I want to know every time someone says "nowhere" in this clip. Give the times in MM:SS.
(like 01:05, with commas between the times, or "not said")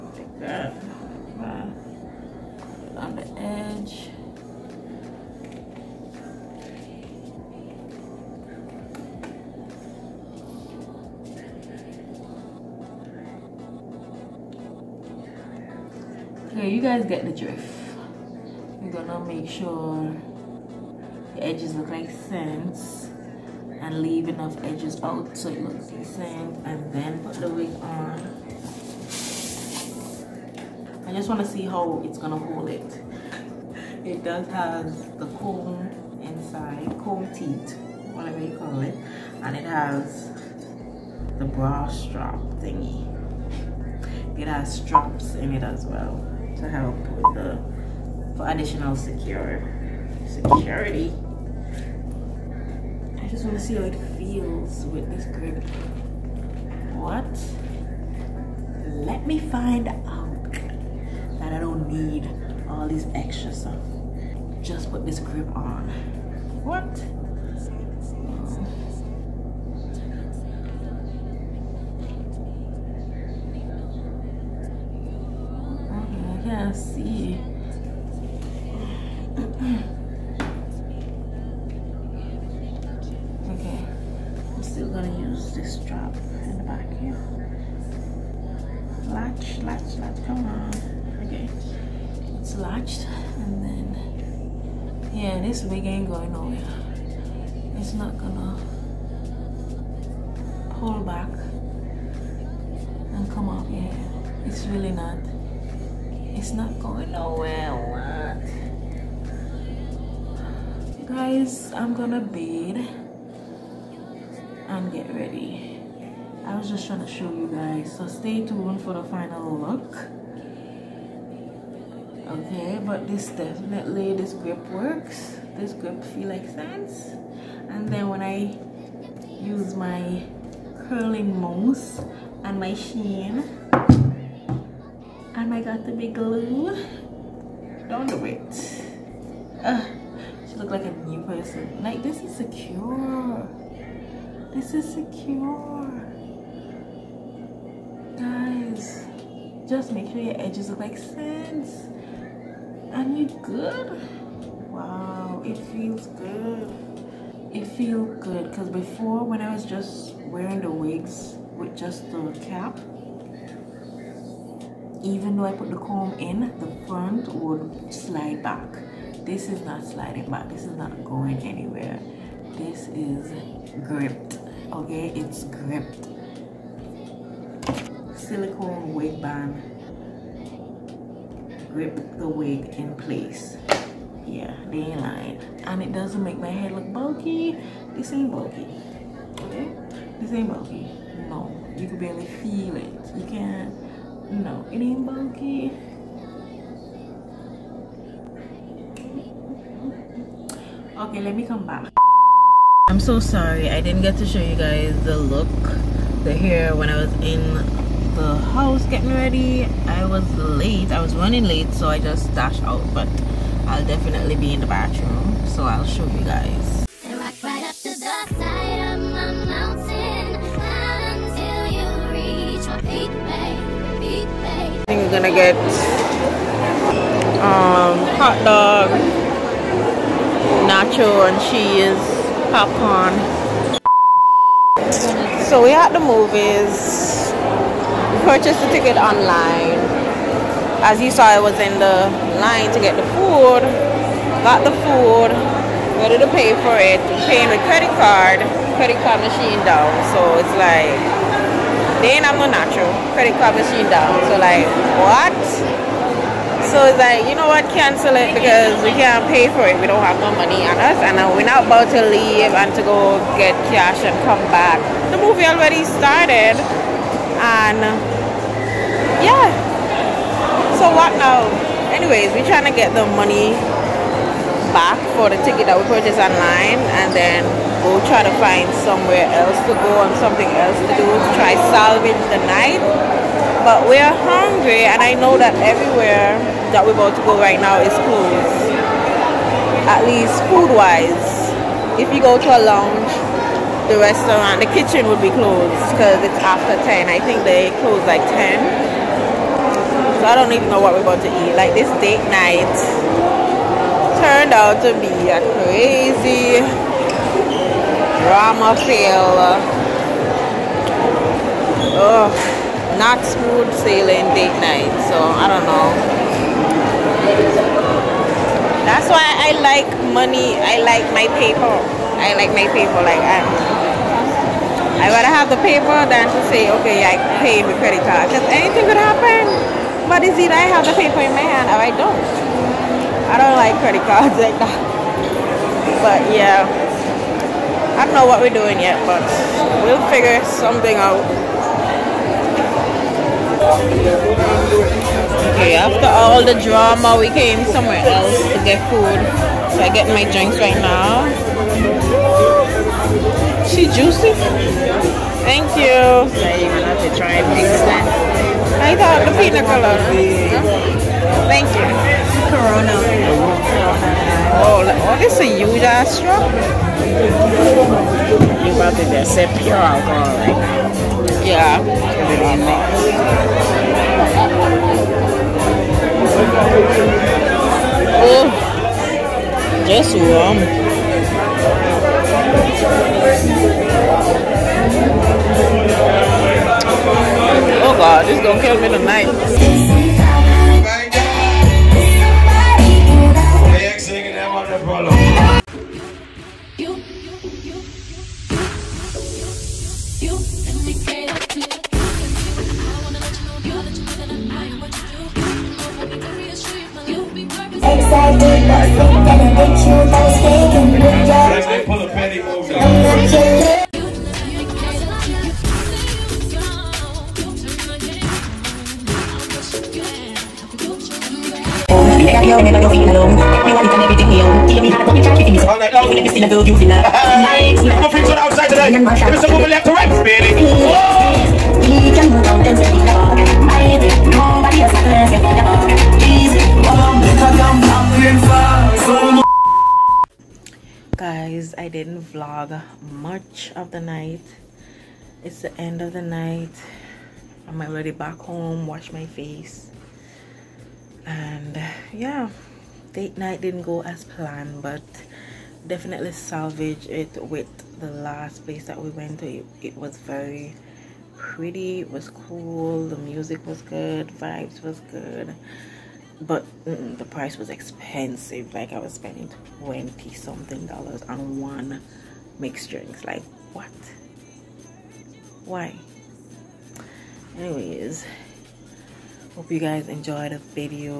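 01:36, 01:47.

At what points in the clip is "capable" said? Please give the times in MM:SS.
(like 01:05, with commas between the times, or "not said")
not said.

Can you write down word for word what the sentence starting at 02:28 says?
Guys, just make sure your edges look like sense.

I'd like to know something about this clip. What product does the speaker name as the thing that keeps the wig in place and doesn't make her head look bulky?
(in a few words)
silicone wig band.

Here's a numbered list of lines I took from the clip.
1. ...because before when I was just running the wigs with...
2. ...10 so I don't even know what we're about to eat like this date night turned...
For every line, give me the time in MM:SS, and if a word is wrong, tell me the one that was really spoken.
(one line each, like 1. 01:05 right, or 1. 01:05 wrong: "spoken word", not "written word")
1. 02:38 wrong: "wearing", not "running"
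2. 04:58 right.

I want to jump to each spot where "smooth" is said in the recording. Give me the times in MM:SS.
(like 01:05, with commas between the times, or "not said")
05:13.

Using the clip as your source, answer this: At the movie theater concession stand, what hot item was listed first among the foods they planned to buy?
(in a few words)
hot dog.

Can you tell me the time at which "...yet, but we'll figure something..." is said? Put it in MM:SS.
05:38.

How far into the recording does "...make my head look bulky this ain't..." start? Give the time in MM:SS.
03:06.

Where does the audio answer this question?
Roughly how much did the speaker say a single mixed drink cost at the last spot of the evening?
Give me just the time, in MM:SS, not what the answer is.
07:49.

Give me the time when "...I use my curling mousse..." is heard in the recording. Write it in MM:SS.
02:08.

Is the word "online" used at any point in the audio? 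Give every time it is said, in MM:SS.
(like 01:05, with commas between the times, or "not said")
03:58, 04:36.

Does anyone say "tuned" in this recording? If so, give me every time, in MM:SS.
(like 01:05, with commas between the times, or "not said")
01:58.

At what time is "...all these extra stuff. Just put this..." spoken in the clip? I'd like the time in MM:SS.
01:02.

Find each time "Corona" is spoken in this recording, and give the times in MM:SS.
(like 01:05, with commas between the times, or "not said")
06:02.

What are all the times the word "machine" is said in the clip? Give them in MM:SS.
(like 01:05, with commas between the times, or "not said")
04:09, 04:13.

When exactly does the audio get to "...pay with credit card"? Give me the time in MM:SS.
05:27.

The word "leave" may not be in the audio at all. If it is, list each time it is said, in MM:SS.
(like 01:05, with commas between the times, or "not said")
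00:24, 04:22.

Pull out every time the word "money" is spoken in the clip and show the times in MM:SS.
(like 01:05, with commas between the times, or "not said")
04:20, 04:33, 05:20.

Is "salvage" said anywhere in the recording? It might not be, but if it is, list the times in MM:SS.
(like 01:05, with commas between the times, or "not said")
04:41, 07:36.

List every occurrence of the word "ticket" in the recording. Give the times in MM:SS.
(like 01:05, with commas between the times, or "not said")
03:58, 04:35.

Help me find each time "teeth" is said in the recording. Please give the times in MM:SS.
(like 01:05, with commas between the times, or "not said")
00:37.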